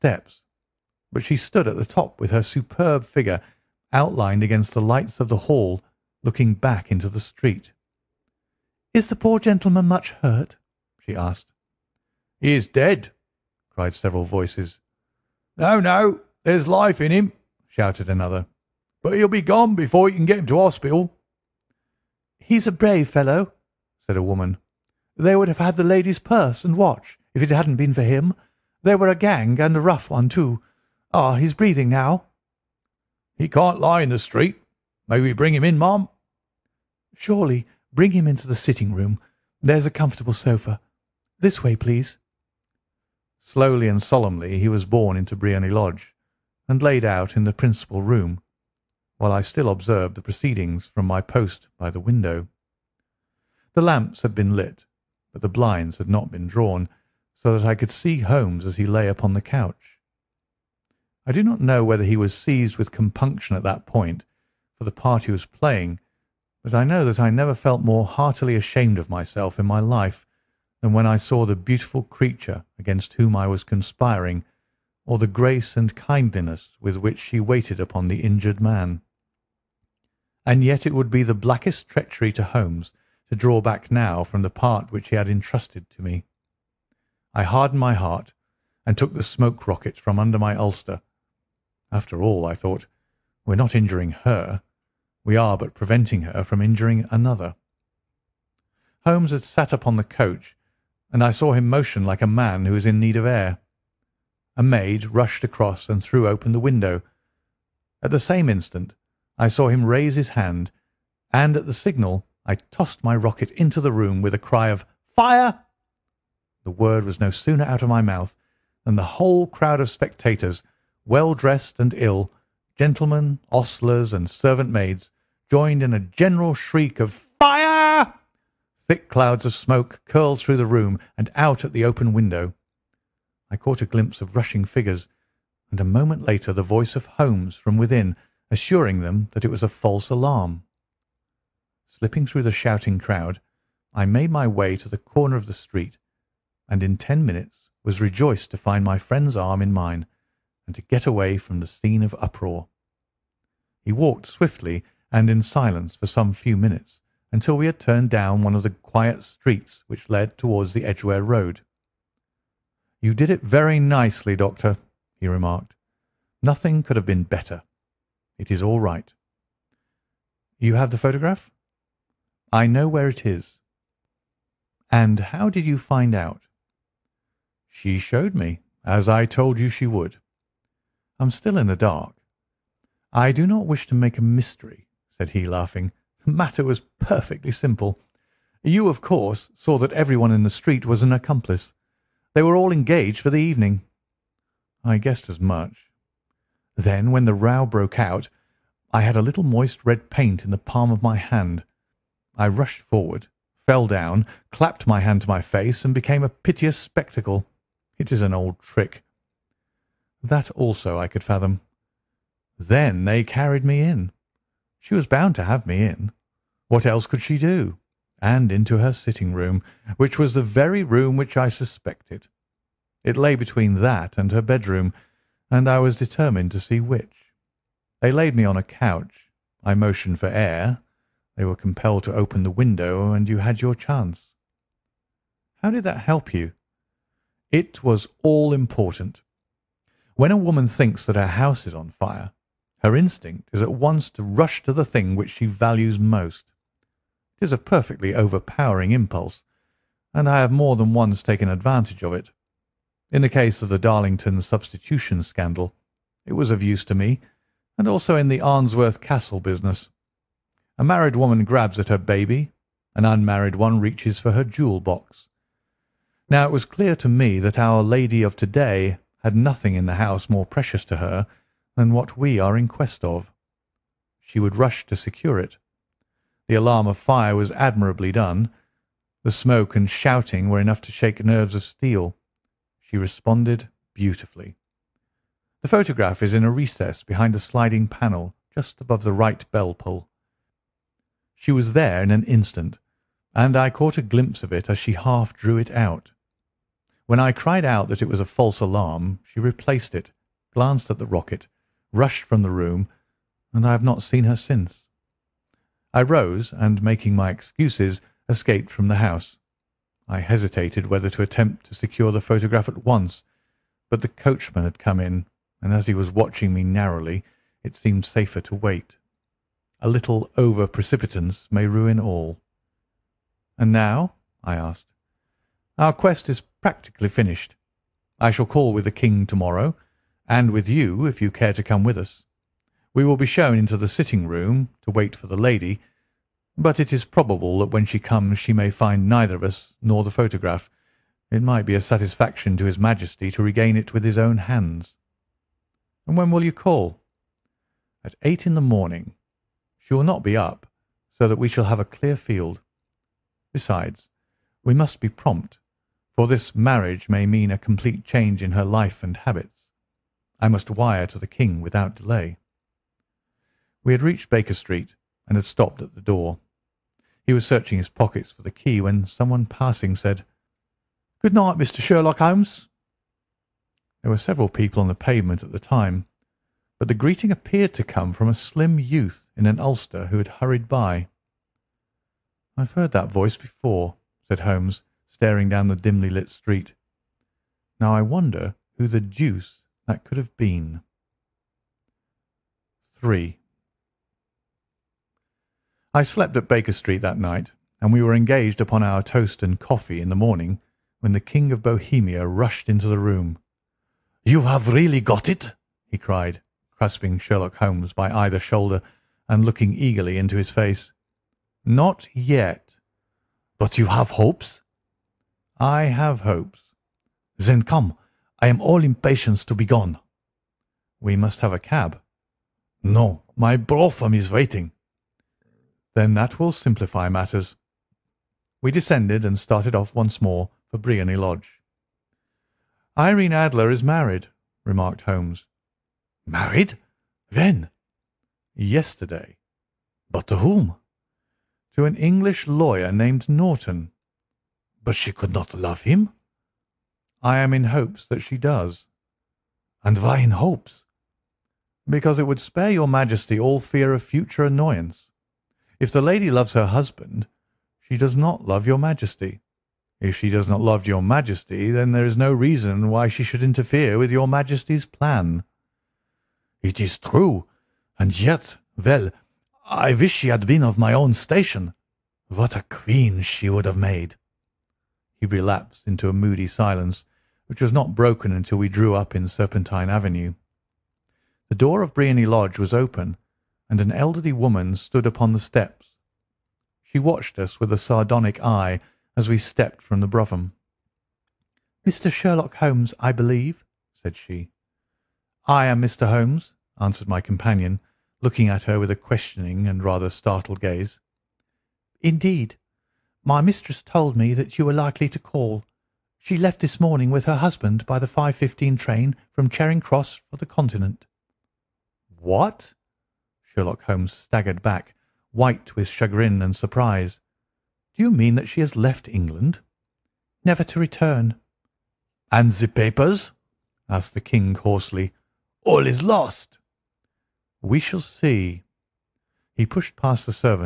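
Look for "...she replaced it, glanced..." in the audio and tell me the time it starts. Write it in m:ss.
4:59.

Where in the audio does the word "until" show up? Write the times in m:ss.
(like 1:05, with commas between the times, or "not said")
2:37, 7:58.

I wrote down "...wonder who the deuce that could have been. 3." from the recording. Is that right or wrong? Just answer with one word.
right.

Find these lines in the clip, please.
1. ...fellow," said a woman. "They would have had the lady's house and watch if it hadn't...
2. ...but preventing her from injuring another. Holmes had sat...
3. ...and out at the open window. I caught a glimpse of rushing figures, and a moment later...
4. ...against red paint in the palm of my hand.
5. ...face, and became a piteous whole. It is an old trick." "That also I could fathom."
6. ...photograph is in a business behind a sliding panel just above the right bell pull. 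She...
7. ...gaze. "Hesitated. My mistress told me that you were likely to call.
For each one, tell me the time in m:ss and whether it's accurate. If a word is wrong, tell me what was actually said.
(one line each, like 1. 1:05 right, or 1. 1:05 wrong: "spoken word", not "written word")
1. 0:23 wrong: "purse", not "house"
2. 1:35 right
3. 2:11 right
4. 3:19 wrong: "moist", not "against"
5. 3:25 wrong: "spectacle", not "whole"
6. 4:45 wrong: "recess", not "business"
7. 8:20 wrong: "Indeed", not "Hesitated".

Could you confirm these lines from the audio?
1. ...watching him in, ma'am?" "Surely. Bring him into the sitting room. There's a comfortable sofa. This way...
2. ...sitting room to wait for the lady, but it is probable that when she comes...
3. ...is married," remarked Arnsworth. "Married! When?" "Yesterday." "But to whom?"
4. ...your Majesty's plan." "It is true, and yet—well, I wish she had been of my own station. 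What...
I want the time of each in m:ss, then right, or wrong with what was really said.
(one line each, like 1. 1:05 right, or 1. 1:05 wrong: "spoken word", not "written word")
1. 0:35 wrong: "bring", not "watching"
2. 5:33 right
3. 7:13 wrong: "Holmes", not "Arnsworth"
4. 7:44 right.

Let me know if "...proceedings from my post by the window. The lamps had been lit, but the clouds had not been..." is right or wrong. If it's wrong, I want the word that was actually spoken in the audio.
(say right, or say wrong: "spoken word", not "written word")
wrong: "blinds", not "clouds".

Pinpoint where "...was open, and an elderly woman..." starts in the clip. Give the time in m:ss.
8:02.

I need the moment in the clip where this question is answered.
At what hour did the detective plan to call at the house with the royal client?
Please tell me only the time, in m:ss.
5:48.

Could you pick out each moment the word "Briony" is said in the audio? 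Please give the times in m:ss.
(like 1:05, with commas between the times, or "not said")
0:45, 7:10, 8:01.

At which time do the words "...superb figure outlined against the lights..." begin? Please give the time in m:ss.
0:02.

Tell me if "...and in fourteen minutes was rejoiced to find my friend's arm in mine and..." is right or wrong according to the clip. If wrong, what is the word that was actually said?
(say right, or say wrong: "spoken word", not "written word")
wrong: "ten", not "fourteen".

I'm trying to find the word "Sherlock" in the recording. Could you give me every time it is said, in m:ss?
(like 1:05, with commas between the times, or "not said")
6:11, 6:47, 8:12, 8:33.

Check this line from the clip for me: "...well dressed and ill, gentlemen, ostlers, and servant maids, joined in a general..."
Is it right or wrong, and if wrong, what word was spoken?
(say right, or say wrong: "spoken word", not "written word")
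right.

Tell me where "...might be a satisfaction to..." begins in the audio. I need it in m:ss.
5:41.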